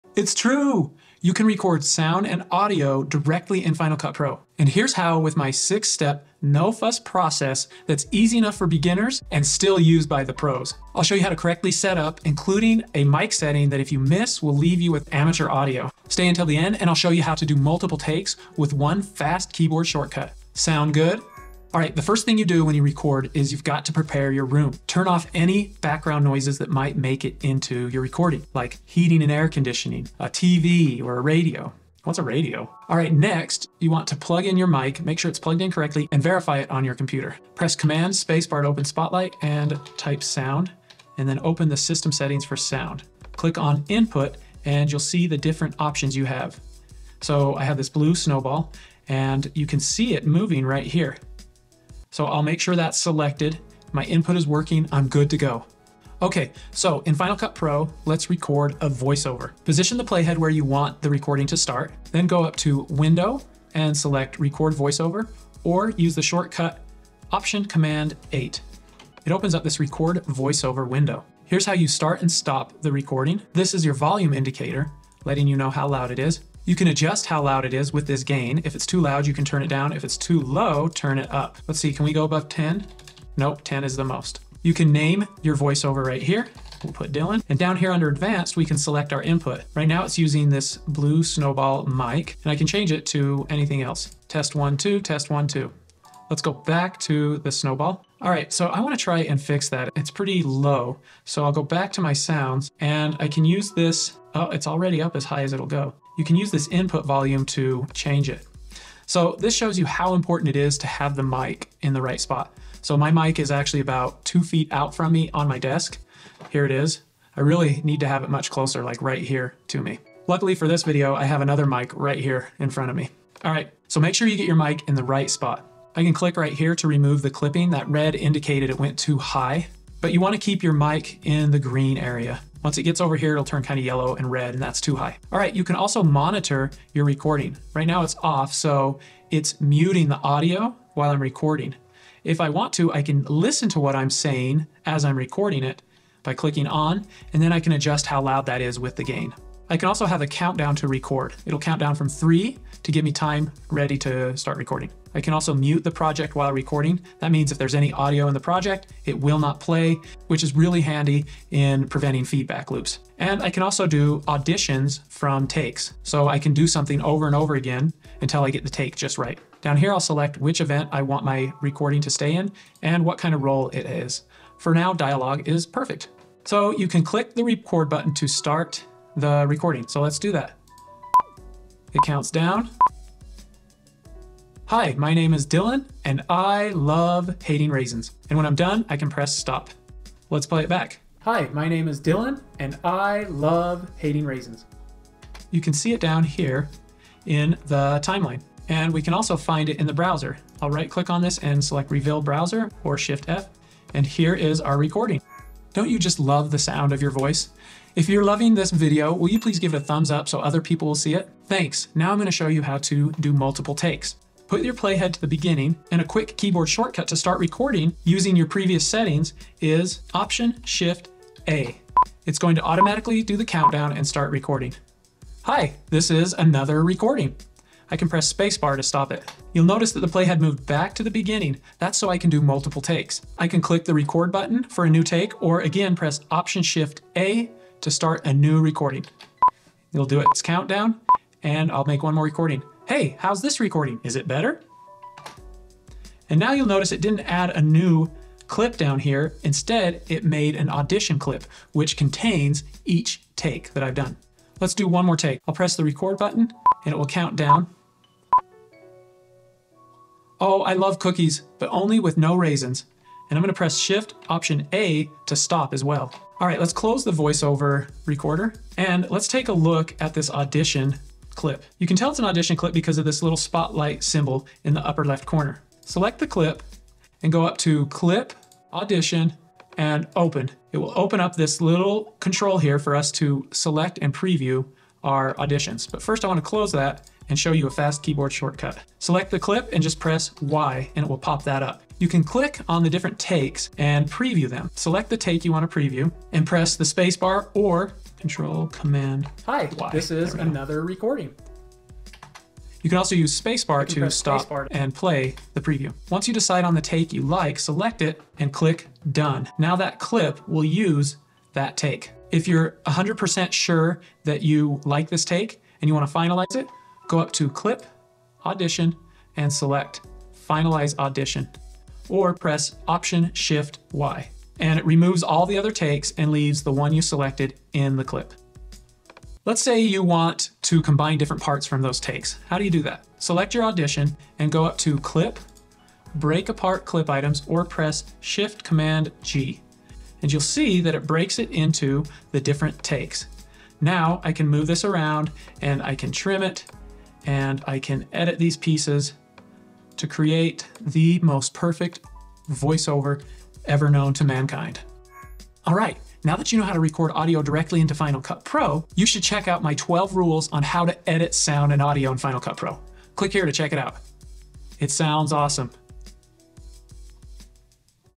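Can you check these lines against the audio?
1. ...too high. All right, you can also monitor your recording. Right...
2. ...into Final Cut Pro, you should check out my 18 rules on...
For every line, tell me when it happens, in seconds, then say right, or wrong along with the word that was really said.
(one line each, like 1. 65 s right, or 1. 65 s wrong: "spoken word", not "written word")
1. 134 s right
2. 357 s wrong: "12", not "18".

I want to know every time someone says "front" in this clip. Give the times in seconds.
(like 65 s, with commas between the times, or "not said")
122 s.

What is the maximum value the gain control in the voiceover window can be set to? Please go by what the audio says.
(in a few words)
10.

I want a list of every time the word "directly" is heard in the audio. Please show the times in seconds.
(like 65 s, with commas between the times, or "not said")
3 s, 357 s.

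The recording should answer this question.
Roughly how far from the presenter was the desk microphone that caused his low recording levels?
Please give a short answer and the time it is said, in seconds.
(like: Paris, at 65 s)
Two feet, at 114 s.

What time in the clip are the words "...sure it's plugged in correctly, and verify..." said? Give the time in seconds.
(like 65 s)
35 s.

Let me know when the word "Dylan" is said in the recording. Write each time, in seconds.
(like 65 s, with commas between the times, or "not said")
87 s, 185 s, 191 s.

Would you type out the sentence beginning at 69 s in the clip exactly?
It opens up this Record Voiceover window.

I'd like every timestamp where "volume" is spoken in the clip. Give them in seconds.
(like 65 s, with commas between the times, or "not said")
73 s, 107 s.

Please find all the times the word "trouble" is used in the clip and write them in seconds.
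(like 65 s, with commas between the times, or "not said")
not said.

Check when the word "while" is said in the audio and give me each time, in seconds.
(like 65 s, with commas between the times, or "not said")
140 s, 156 s.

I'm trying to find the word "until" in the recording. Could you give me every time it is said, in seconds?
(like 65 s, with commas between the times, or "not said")
16 s, 168 s.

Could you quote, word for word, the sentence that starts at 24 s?
Turn off any background noises that might make it into your recording, like heating and air conditioning, a TV or a radio.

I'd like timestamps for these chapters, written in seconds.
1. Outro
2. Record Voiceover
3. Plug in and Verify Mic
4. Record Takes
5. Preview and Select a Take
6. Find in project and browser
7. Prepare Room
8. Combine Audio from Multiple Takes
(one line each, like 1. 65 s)
1. 355 s
2. 55 s
3. 33 s
4. 213 s
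5. 267 s
6. 198 s
7. 21 s
8. 328 s.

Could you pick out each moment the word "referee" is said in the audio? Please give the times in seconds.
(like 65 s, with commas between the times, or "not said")
not said.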